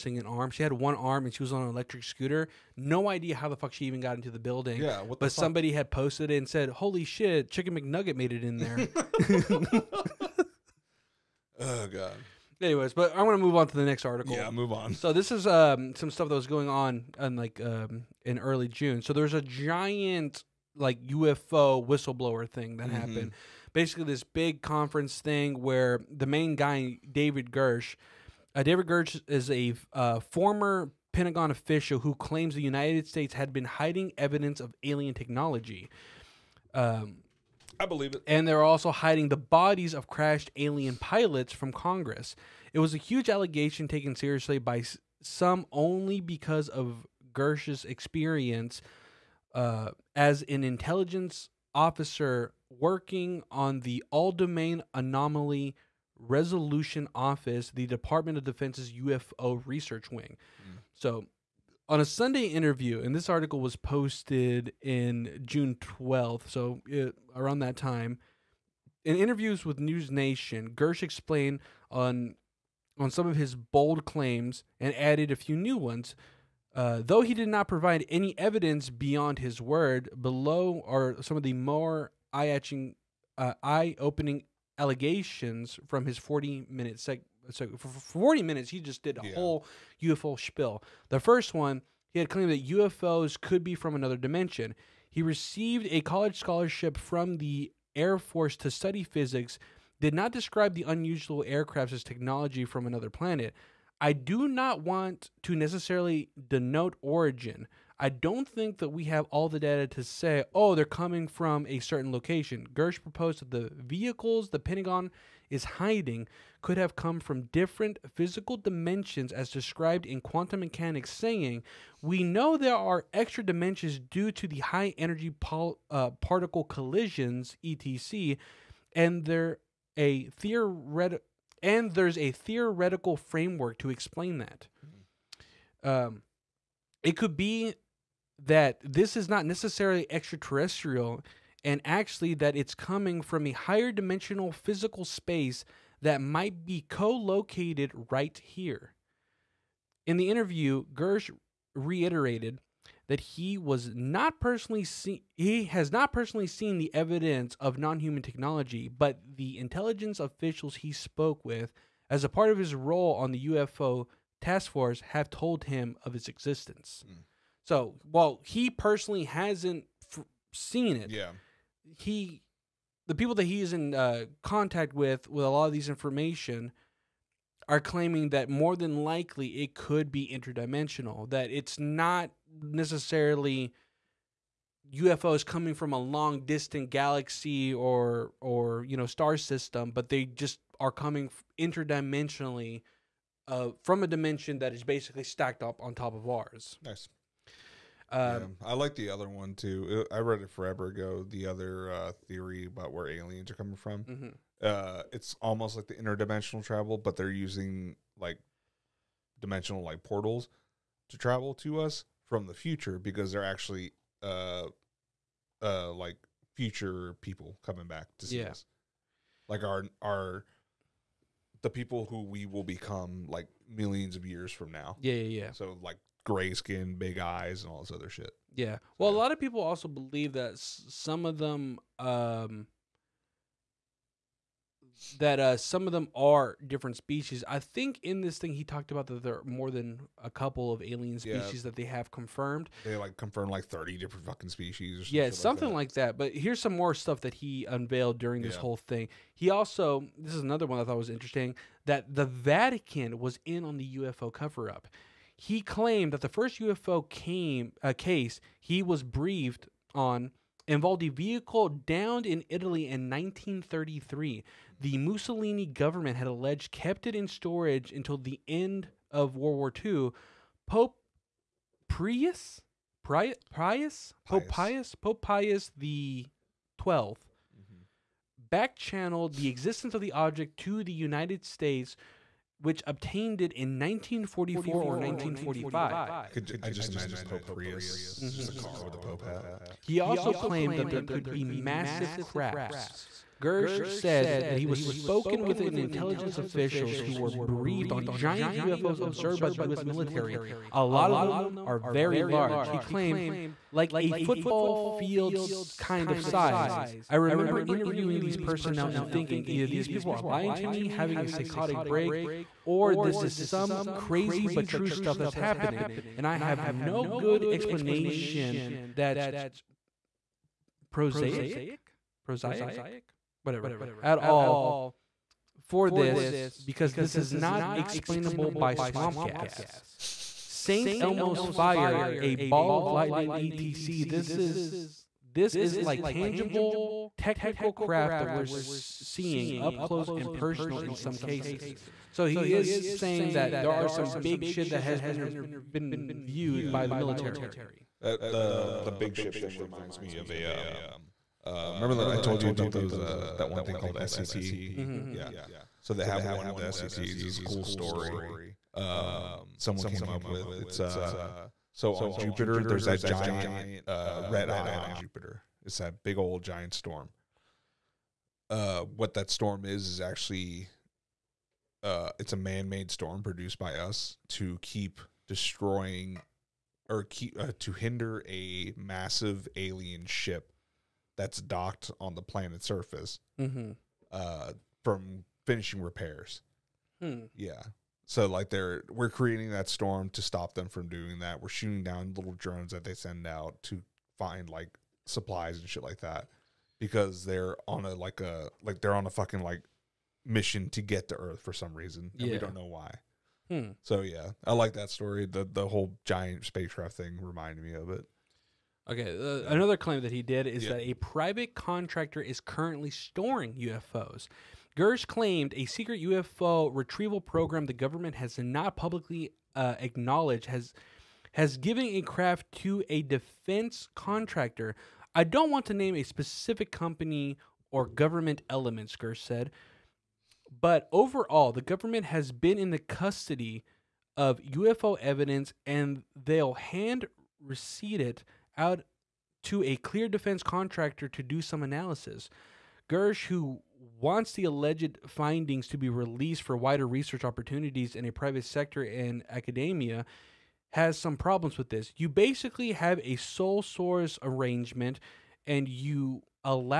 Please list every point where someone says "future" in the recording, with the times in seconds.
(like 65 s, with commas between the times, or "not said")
212 s, 216 s.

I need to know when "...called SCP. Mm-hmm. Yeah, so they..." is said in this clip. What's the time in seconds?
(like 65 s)
353 s.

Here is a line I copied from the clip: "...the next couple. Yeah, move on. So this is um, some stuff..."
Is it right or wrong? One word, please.
wrong.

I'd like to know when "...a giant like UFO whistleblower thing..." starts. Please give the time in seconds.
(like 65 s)
19 s.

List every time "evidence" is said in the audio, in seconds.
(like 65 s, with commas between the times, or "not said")
34 s, 78 s, 156 s, 434 s.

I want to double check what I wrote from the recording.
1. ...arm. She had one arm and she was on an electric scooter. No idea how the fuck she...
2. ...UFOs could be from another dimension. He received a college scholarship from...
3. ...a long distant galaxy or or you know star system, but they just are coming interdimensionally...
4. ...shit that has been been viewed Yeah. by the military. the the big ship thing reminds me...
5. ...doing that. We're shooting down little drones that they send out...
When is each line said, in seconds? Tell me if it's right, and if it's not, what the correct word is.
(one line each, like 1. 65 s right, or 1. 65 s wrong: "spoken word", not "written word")
1. 0 s right
2. 92 s right
3. 185 s right
4. 344 s right
5. 390 s right.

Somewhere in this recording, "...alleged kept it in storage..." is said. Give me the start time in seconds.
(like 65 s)
266 s.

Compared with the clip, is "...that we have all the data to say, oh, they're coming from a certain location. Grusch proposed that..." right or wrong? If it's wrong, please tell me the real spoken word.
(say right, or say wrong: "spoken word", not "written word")
right.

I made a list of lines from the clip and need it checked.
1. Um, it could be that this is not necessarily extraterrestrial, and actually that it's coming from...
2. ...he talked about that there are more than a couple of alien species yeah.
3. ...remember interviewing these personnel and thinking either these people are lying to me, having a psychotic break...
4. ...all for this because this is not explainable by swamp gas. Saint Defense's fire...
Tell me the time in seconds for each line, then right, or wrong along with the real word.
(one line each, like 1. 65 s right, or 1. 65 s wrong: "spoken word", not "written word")
1. 135 s right
2. 238 s right
3. 307 s right
4. 324 s wrong: "Elmo", not "Defense".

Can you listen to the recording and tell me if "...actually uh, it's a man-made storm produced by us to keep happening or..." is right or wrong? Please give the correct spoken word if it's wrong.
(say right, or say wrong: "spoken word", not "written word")
wrong: "destroying", not "happening".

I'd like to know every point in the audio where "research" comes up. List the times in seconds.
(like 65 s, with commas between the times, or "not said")
59 s, 446 s.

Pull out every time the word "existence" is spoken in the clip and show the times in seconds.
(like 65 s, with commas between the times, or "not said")
166 s, 279 s.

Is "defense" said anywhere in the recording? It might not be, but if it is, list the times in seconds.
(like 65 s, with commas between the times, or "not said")
58 s, 423 s, 440 s.